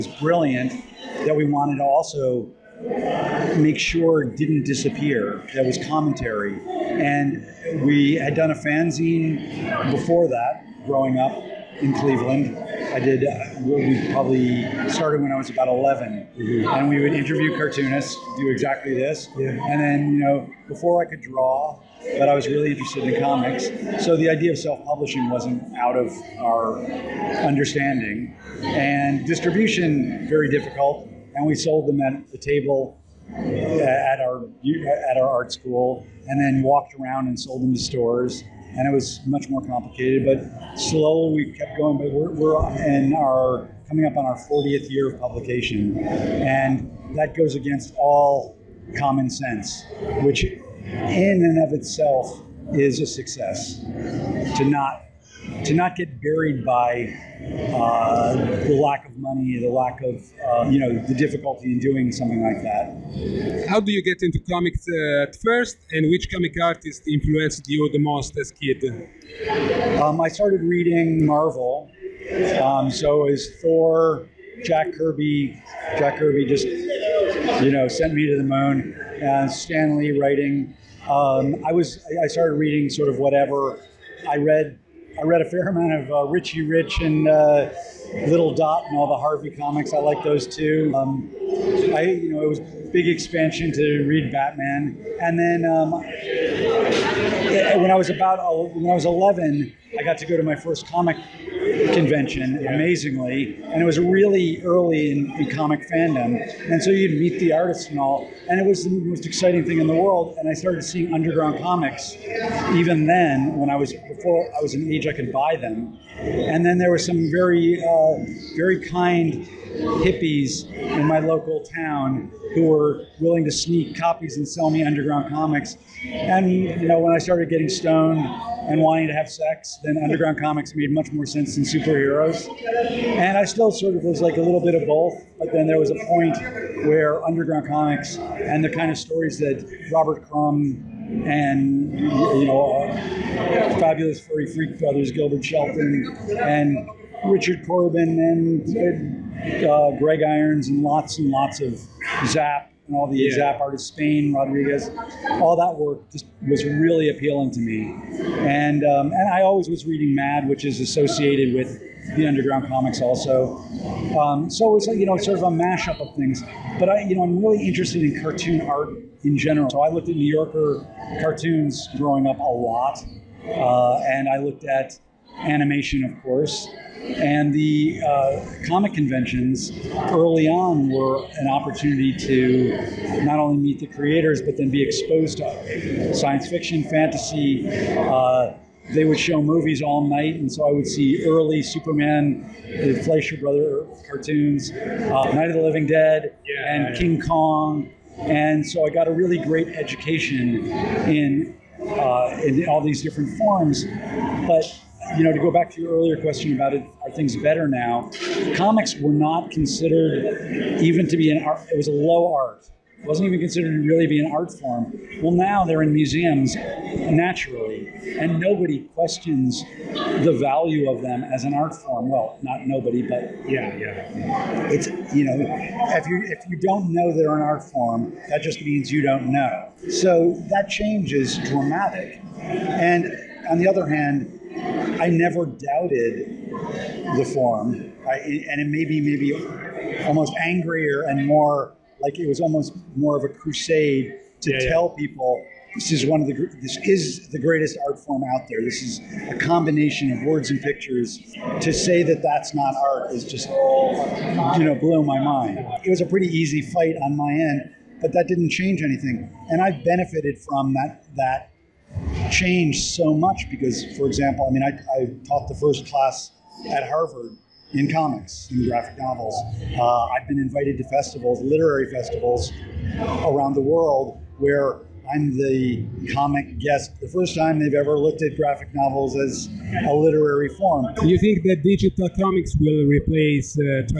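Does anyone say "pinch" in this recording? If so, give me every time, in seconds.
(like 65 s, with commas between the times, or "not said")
not said.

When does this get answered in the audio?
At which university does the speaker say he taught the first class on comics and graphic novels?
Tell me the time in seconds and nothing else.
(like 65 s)
266 s.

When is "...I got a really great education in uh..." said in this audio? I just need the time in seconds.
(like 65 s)
198 s.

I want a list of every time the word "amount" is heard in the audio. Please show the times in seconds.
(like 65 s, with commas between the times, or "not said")
85 s.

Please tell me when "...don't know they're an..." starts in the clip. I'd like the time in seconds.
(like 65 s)
226 s.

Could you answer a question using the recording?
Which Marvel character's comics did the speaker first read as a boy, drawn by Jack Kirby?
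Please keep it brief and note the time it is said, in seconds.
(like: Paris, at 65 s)
Thor, at 73 s.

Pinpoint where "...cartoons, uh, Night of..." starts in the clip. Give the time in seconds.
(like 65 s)
194 s.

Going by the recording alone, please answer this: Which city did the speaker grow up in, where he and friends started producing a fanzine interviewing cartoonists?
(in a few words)
Cleveland.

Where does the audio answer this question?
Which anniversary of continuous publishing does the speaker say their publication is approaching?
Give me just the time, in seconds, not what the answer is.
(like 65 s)
44 s.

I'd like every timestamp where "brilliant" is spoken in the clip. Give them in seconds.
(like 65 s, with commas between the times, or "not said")
0 s.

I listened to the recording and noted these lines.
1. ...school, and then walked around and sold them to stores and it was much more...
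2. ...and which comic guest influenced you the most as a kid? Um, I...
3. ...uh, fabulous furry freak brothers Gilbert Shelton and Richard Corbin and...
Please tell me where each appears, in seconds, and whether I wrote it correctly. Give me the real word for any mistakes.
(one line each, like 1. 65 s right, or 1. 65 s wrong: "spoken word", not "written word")
1. 35 s right
2. 65 s wrong: "artist", not "guest"
3. 142 s right.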